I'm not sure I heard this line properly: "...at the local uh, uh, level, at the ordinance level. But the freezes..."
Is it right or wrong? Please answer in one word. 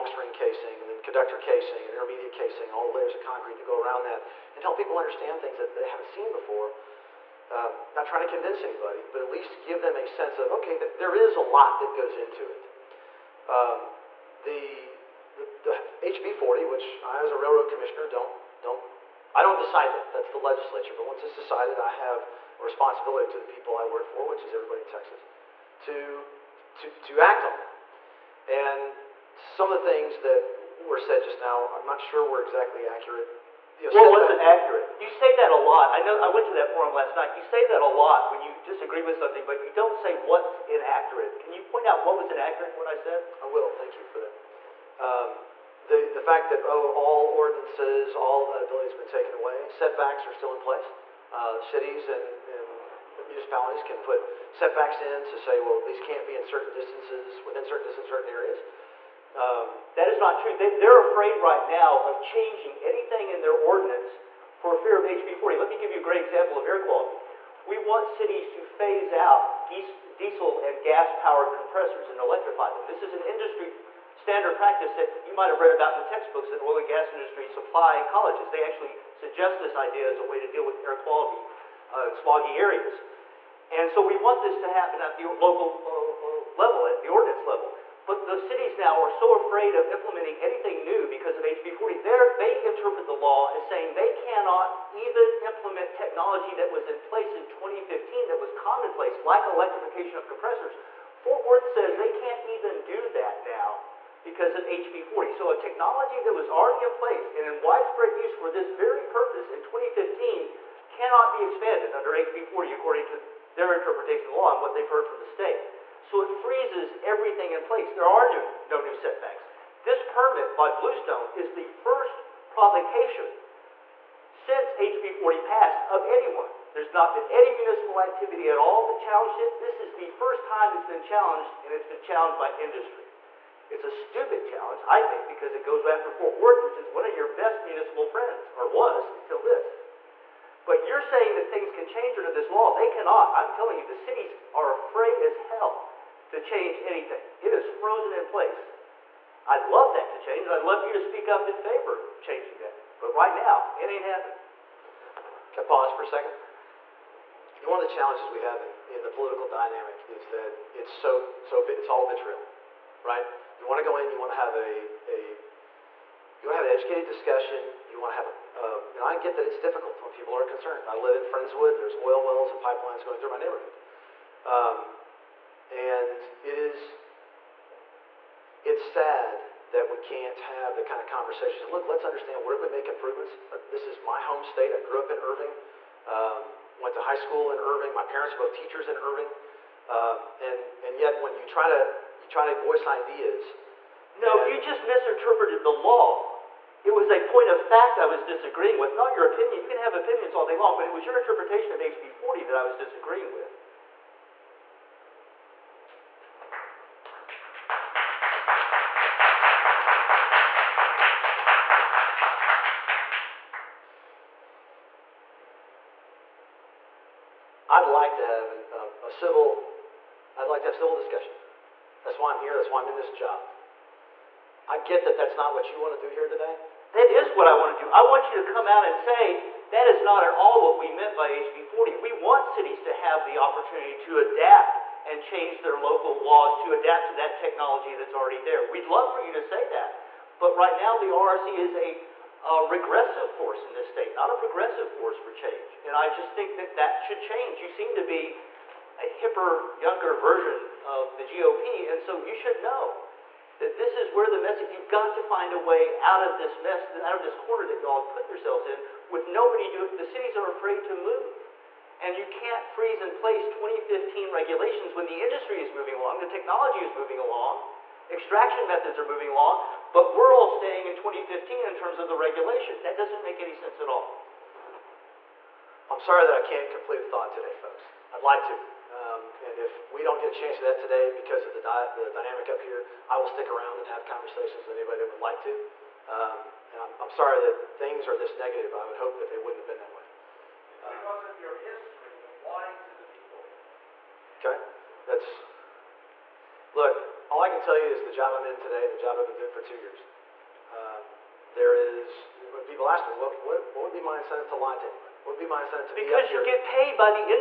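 wrong.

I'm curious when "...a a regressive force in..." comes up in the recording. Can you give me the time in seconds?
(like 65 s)
241 s.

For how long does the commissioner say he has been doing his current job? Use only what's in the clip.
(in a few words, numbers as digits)
2 years.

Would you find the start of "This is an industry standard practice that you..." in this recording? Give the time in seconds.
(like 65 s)
72 s.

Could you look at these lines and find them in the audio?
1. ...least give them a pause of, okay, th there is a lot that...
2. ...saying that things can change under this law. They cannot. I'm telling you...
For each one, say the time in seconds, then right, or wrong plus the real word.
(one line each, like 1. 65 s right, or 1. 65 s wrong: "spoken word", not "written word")
1. 9 s wrong: "sense", not "pause"
2. 141 s right.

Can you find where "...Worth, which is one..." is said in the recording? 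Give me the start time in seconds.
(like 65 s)
136 s.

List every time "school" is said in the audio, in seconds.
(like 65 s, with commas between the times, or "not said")
187 s.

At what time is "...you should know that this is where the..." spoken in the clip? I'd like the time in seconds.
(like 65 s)
252 s.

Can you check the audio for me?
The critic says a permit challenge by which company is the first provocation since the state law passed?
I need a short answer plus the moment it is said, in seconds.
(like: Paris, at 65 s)
Bluestone, at 120 s.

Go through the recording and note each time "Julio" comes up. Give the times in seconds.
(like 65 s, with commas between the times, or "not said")
not said.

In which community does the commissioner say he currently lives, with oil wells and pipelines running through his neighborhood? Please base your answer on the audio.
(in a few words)
Friendswood.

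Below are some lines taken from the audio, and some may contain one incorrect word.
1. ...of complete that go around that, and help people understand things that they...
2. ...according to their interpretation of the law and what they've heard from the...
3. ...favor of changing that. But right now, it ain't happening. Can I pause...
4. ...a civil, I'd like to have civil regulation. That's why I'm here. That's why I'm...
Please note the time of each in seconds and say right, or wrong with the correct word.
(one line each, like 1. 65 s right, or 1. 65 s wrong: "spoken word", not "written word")
1. 3 s wrong: "concrete", not "complete"
2. 112 s right
3. 151 s right
4. 219 s wrong: "discussion", not "regulation".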